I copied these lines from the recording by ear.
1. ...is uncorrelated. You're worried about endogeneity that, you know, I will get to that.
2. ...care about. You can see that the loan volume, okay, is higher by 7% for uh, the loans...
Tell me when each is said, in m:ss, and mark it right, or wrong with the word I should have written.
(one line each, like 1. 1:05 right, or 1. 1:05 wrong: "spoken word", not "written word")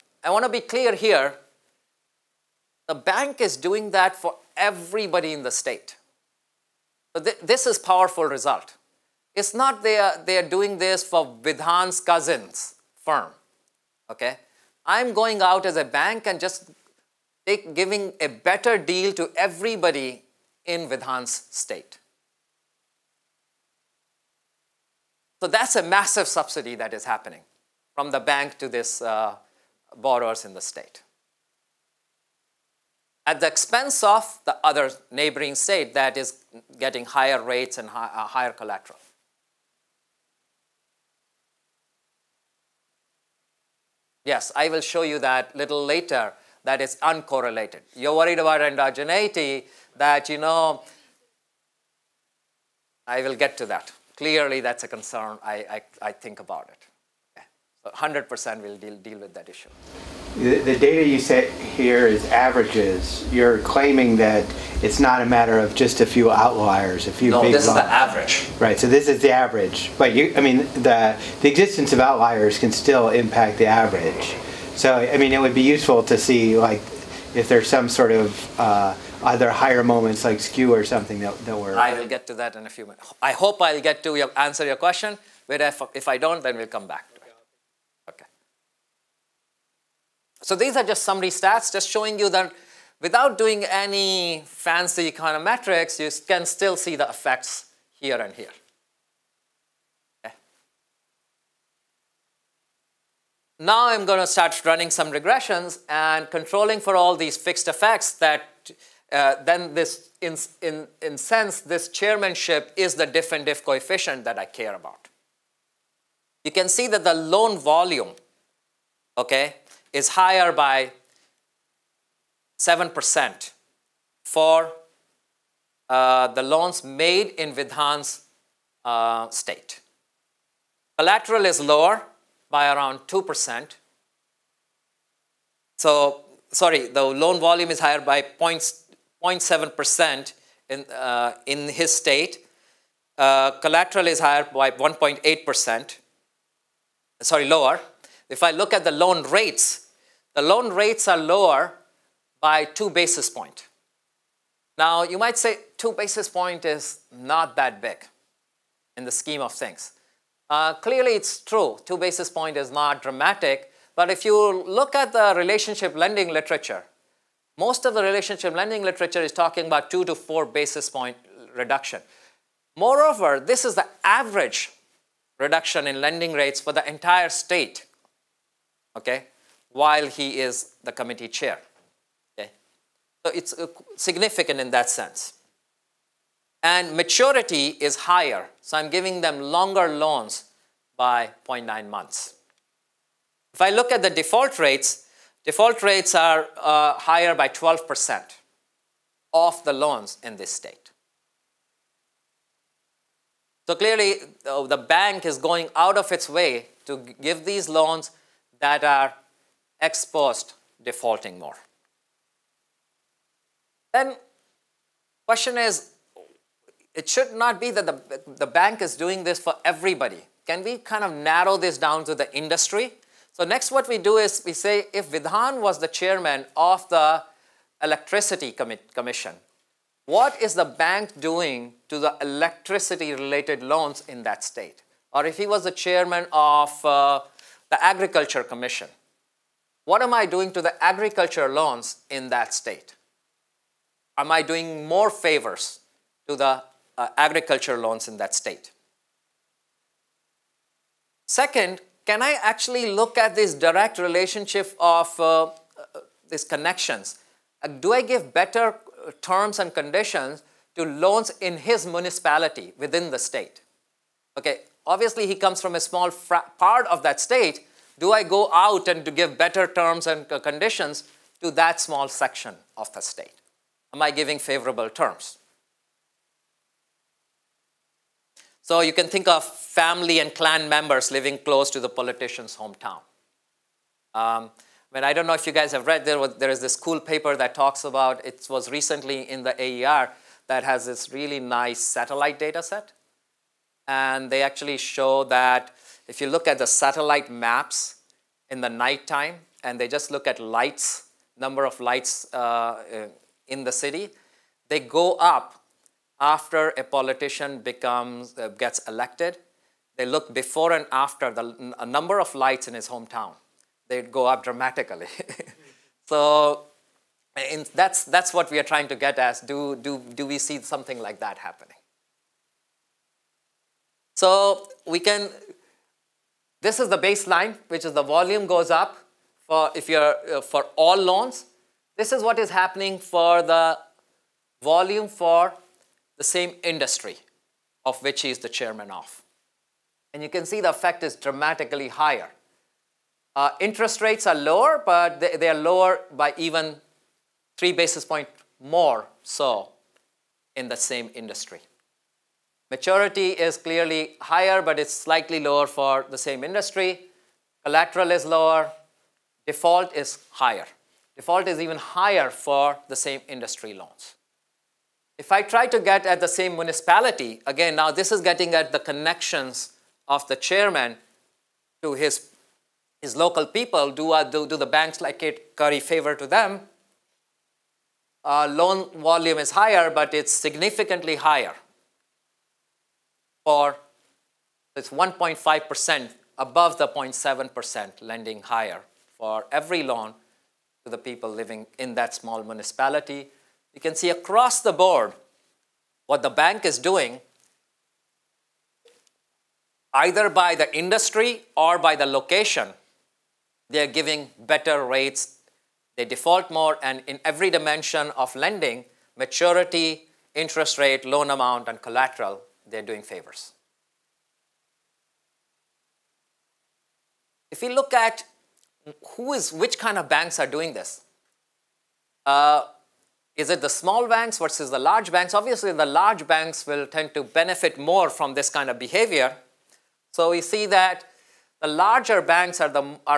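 1. 0:46 right
2. 1:54 right.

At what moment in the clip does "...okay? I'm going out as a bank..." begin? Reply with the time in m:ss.
0:14.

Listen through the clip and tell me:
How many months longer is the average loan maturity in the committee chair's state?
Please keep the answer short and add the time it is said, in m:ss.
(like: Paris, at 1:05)
0.9 months, at 3:11.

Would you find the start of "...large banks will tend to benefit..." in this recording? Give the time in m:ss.
7:05.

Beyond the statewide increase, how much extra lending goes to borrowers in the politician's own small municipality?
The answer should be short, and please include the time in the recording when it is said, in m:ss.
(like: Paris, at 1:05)
1.5%, at 6:24.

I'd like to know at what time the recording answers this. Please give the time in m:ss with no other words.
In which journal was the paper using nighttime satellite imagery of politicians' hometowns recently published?
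4:49.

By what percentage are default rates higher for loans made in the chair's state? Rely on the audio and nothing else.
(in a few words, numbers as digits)
12%.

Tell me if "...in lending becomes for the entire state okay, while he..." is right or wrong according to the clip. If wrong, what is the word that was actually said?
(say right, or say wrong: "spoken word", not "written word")
wrong: "rates", not "becomes".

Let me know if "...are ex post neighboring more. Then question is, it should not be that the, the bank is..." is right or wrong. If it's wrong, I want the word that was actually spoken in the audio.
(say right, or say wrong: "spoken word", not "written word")
wrong: "defaulting", not "neighboring".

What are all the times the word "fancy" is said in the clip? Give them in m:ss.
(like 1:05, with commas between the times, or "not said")
1:34.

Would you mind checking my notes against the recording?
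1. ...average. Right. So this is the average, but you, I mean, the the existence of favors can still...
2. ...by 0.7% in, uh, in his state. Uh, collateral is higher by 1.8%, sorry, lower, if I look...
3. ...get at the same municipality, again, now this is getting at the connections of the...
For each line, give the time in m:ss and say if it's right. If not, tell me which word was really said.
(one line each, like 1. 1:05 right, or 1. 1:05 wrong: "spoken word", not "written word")
1. 1:07 wrong: "outliers", not "favors"
2. 2:18 right
3. 6:05 right.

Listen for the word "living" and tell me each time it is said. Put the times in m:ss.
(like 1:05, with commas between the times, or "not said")
4:41, 6:31.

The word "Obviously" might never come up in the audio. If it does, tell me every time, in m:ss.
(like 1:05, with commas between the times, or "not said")
4:24, 7:05.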